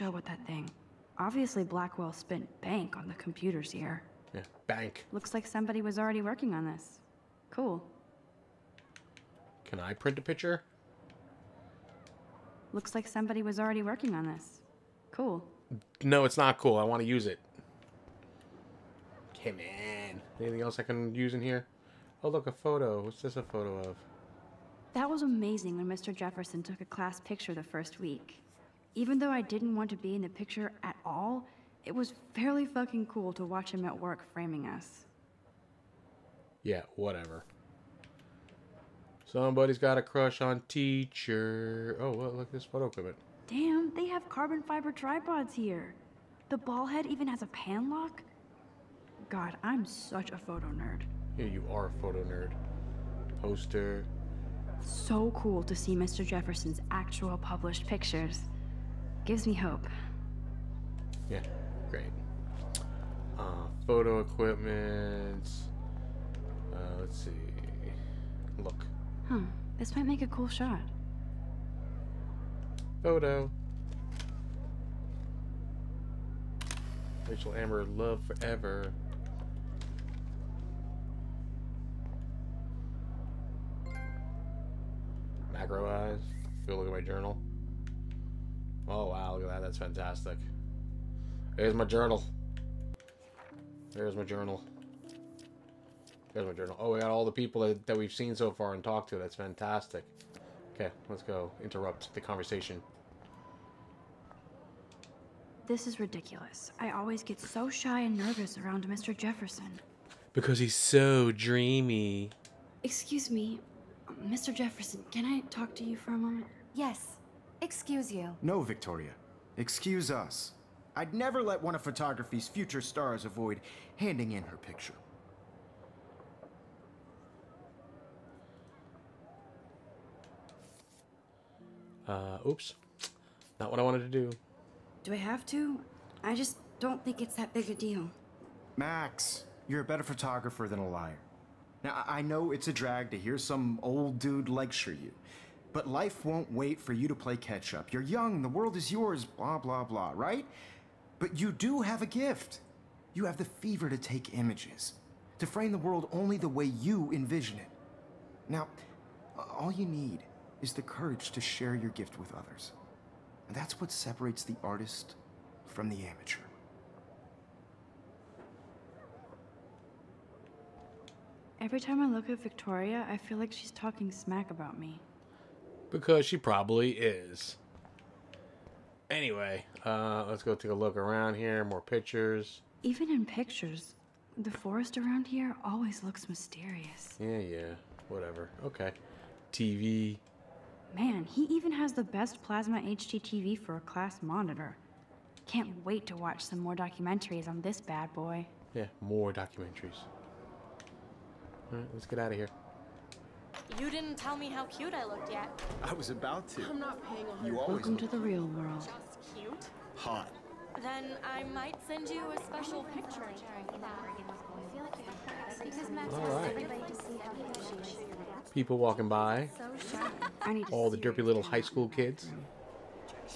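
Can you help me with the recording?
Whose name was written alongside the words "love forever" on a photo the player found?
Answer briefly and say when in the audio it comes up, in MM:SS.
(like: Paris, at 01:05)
Rachel Amber, at 01:17.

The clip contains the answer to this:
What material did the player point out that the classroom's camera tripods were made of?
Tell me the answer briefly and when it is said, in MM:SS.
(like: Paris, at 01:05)
Carbon fiber, at 00:44.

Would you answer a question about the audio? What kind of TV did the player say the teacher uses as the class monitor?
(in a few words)
Plasma HDTV.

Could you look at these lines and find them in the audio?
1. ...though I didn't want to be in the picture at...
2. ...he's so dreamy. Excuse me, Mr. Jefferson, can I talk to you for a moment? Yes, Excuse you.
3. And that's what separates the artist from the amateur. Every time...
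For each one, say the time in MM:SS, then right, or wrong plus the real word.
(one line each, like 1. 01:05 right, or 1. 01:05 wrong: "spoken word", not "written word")
1. 00:29 right
2. 01:50 right
3. 02:43 right.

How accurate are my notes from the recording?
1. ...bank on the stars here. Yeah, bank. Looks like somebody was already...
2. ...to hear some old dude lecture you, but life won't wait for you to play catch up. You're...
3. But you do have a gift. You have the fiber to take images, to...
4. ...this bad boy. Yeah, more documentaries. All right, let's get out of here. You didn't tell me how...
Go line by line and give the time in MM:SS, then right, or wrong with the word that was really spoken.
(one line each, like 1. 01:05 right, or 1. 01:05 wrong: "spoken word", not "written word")
1. 00:02 wrong: "computers", not "stars"
2. 02:23 right
3. 02:31 wrong: "fever", not "fiber"
4. 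03:17 right.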